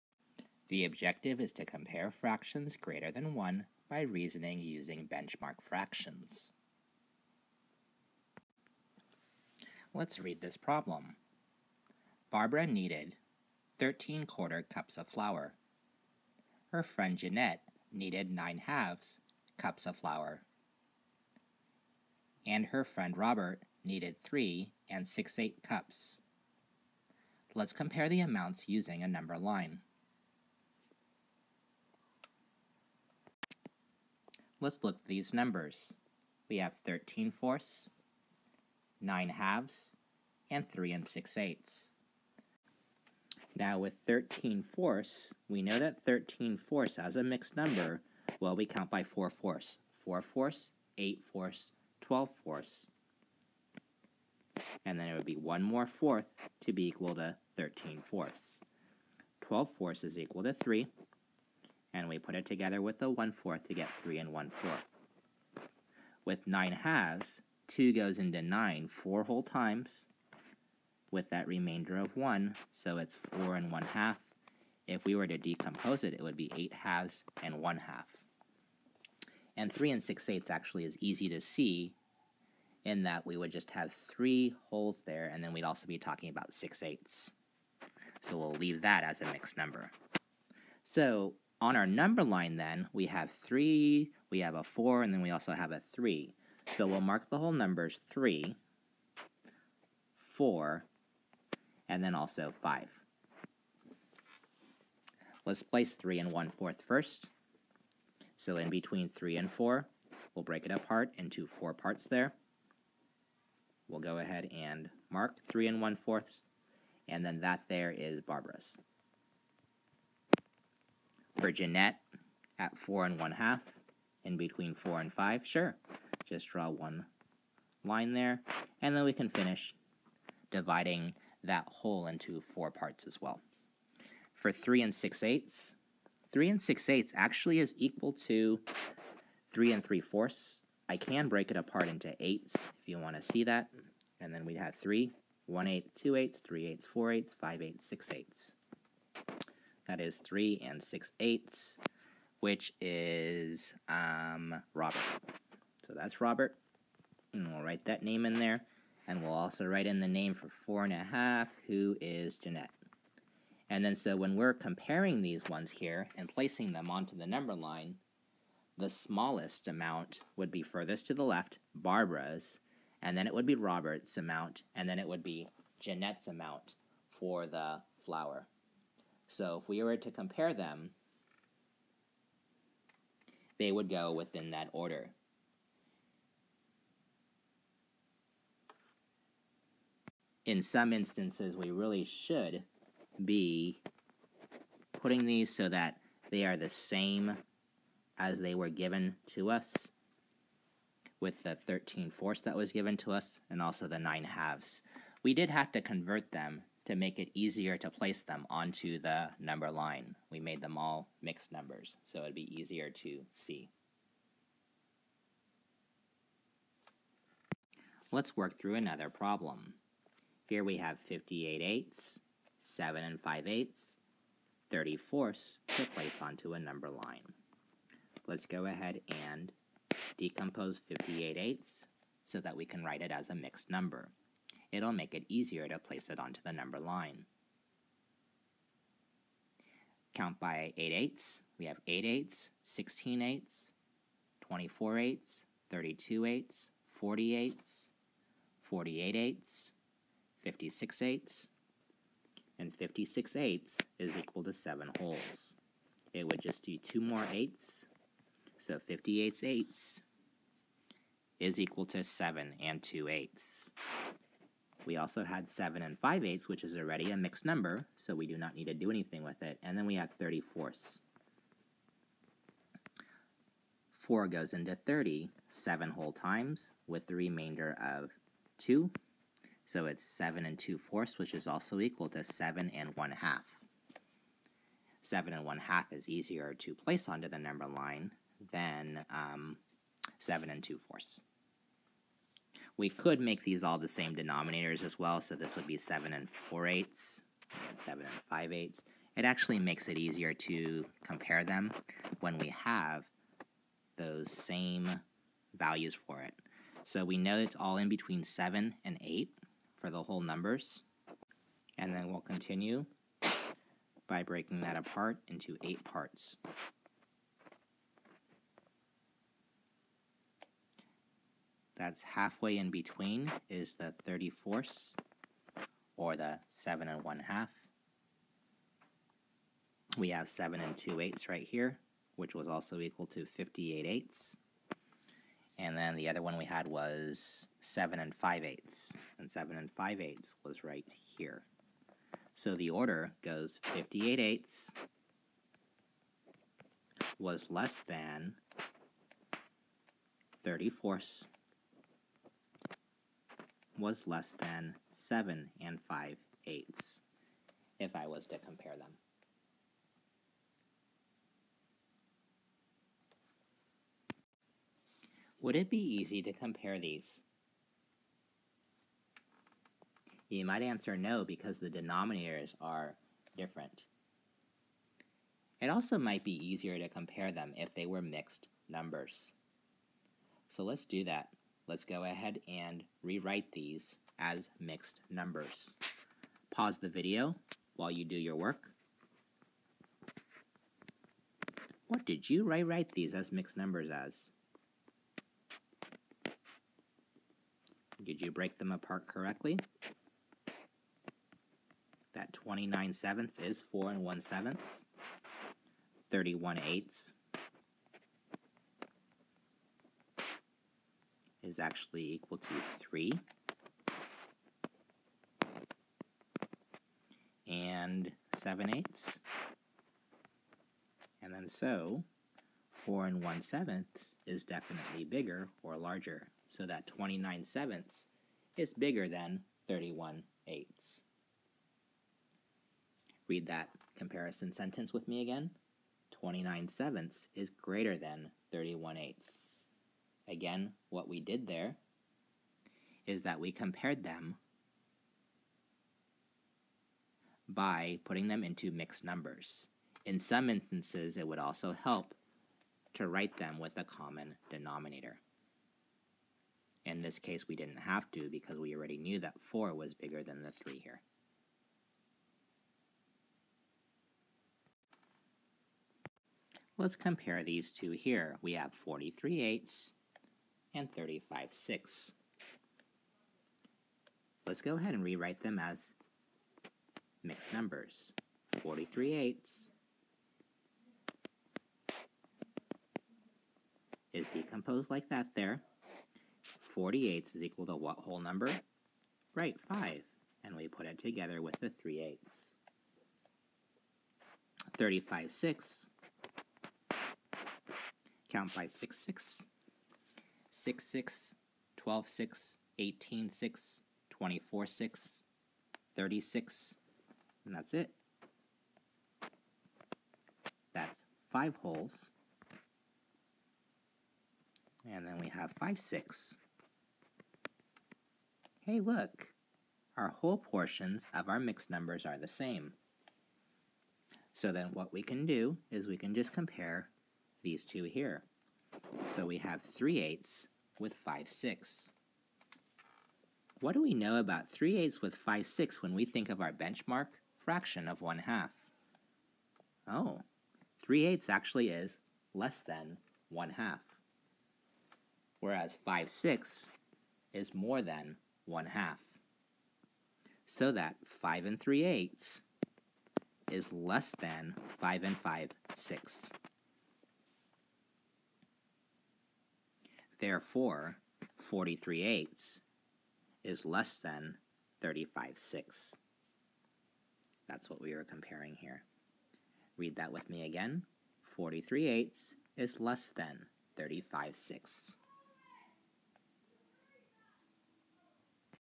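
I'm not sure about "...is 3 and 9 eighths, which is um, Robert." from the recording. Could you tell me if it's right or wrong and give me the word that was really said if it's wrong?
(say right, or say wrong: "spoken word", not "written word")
wrong: "6", not "9".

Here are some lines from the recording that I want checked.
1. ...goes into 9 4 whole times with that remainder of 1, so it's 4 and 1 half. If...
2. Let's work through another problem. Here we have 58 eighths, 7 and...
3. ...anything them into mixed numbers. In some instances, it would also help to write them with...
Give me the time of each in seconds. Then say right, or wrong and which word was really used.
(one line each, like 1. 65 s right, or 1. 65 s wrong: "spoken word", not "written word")
1. 67 s right
2. 218 s right
3. 448 s wrong: "putting", not "anything".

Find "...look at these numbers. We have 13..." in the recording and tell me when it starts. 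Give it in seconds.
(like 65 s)
34 s.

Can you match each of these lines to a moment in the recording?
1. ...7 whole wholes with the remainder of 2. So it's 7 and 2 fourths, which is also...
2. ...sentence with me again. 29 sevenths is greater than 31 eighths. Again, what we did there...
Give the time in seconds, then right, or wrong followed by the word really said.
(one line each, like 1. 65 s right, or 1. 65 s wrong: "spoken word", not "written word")
1. 275 s wrong: "times", not "wholes"
2. 434 s right.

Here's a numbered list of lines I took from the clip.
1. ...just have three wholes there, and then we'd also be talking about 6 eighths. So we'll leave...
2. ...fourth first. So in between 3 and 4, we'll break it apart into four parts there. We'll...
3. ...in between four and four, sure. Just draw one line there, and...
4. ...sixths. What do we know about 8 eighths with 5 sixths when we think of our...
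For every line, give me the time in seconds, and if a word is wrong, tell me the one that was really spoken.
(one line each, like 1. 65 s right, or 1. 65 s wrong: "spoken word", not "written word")
1. 83 s right
2. 106 s right
3. 124 s wrong: "five", not "four"
4. 531 s wrong: "3", not "8".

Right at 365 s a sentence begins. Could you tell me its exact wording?
Would it be easy to compare these?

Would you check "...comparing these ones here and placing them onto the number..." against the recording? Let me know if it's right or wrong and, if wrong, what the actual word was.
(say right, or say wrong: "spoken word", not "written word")
right.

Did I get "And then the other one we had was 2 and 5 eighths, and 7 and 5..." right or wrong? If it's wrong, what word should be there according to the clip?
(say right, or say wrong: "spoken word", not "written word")
wrong: "7", not "2".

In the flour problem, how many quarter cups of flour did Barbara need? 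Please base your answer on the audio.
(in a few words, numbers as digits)
13.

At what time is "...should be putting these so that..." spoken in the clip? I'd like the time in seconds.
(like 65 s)
192 s.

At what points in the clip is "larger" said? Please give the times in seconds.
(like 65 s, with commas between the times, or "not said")
425 s.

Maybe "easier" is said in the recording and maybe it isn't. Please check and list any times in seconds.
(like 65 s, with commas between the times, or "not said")
207 s, 212 s, 235 s, 286 s, 299 s, 376 s.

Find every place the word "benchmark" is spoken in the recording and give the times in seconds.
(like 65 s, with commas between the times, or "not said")
5 s, 536 s.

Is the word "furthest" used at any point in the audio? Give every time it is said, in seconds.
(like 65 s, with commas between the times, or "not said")
170 s.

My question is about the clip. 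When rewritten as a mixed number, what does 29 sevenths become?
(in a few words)
4 and 1/7.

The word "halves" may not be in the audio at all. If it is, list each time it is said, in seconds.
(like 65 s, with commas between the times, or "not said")
18 s, 39 s, 66 s, 76 s, 204 s.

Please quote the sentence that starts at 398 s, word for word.
Did you break them apart correctly?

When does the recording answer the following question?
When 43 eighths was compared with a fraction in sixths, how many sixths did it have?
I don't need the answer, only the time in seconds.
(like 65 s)
470 s.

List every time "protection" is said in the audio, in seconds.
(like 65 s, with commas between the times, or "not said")
not said.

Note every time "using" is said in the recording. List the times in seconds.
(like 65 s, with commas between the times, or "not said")
4 s, 28 s.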